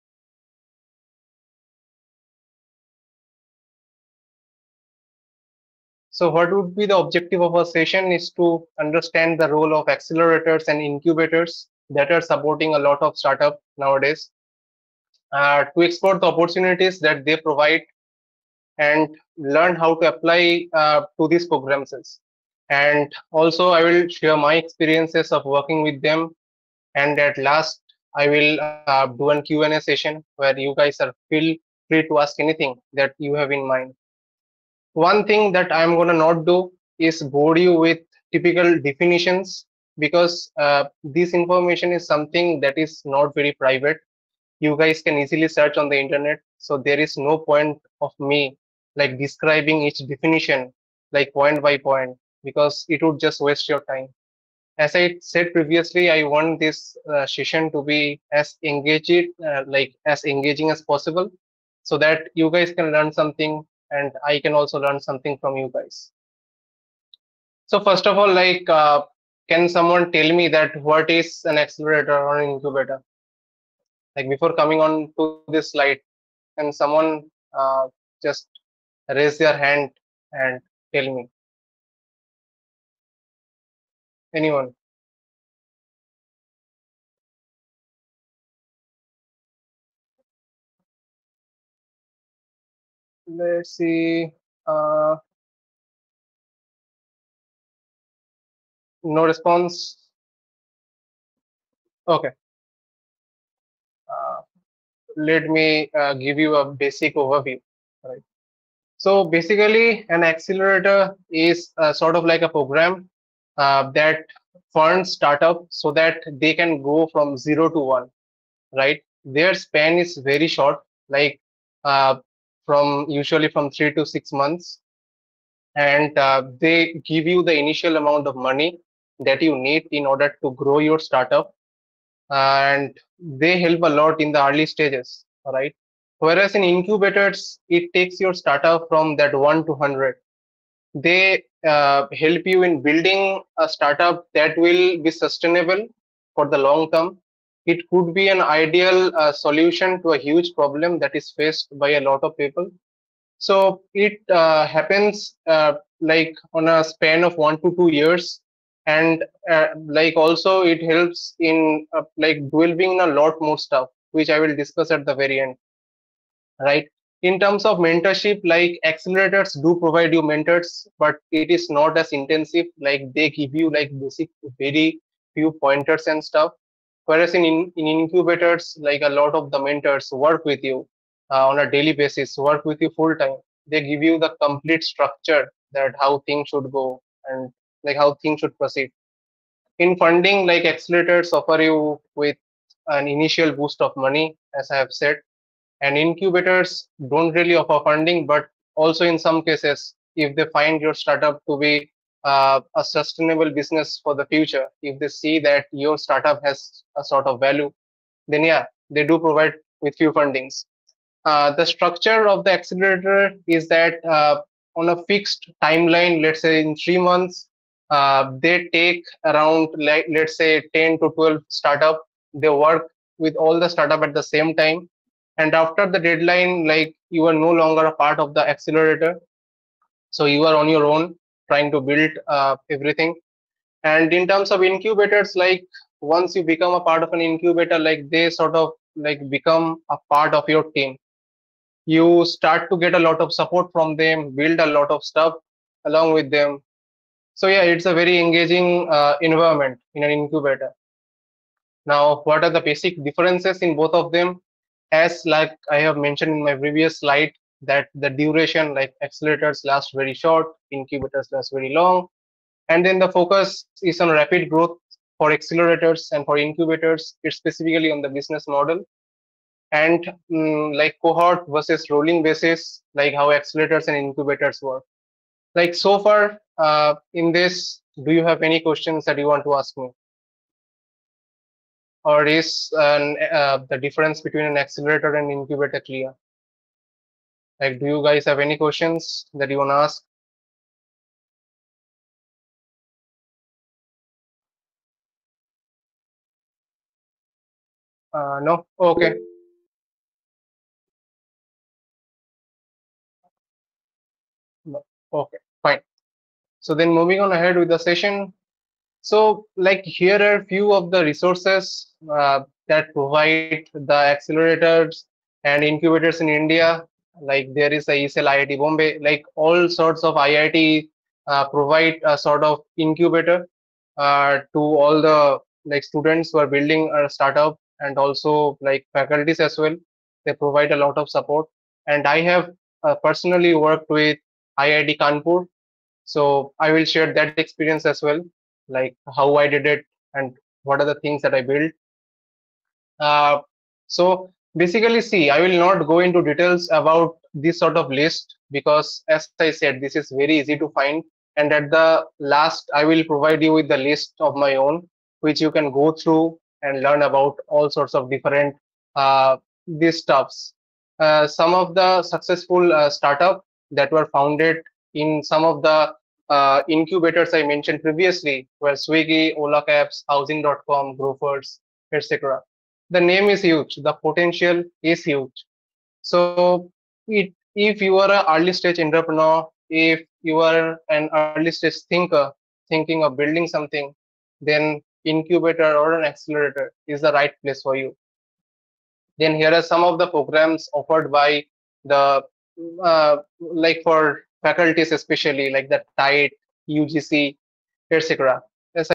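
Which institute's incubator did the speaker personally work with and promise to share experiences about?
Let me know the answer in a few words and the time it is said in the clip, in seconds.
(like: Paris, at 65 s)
IIT Kanpur, at 334 s.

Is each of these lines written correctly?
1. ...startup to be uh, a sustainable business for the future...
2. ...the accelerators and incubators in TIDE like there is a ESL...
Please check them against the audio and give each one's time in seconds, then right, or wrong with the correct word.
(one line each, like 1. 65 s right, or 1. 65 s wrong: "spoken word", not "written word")
1. 201 s right
2. 313 s wrong: "India", not "TIDE".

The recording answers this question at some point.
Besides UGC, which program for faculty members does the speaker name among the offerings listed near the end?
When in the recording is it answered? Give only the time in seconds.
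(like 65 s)
395 s.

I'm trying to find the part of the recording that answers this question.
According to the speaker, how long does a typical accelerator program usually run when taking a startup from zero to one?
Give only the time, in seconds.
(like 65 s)
123 s.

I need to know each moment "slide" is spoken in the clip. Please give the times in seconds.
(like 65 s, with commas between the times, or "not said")
75 s, 257 s.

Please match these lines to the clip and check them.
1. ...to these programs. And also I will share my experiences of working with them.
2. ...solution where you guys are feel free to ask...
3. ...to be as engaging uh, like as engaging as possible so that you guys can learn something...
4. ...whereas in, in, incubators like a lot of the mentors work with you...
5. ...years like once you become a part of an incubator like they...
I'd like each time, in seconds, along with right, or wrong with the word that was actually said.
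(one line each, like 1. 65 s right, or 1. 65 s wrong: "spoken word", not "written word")
1. 21 s right
2. 29 s wrong: "session", not "solution"
3. 57 s right
4. 177 s right
5. 234 s wrong: "incubators", not "years".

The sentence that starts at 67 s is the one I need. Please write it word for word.
So first of all, like, uh, can someone tell me that what is an accelerator or an incubator?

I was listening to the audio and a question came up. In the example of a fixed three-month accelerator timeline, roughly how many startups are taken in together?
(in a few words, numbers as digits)
10 to 12.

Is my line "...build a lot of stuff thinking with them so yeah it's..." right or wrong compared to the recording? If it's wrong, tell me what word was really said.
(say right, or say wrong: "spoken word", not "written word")
wrong: "along", not "thinking".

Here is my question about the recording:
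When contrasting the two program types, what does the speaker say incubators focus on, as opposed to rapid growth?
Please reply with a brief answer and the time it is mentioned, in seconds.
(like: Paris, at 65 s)
the business model, at 268 s.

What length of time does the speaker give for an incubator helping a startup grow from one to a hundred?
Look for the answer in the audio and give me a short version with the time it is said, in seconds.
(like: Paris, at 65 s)
1 to 2 years, at 157 s.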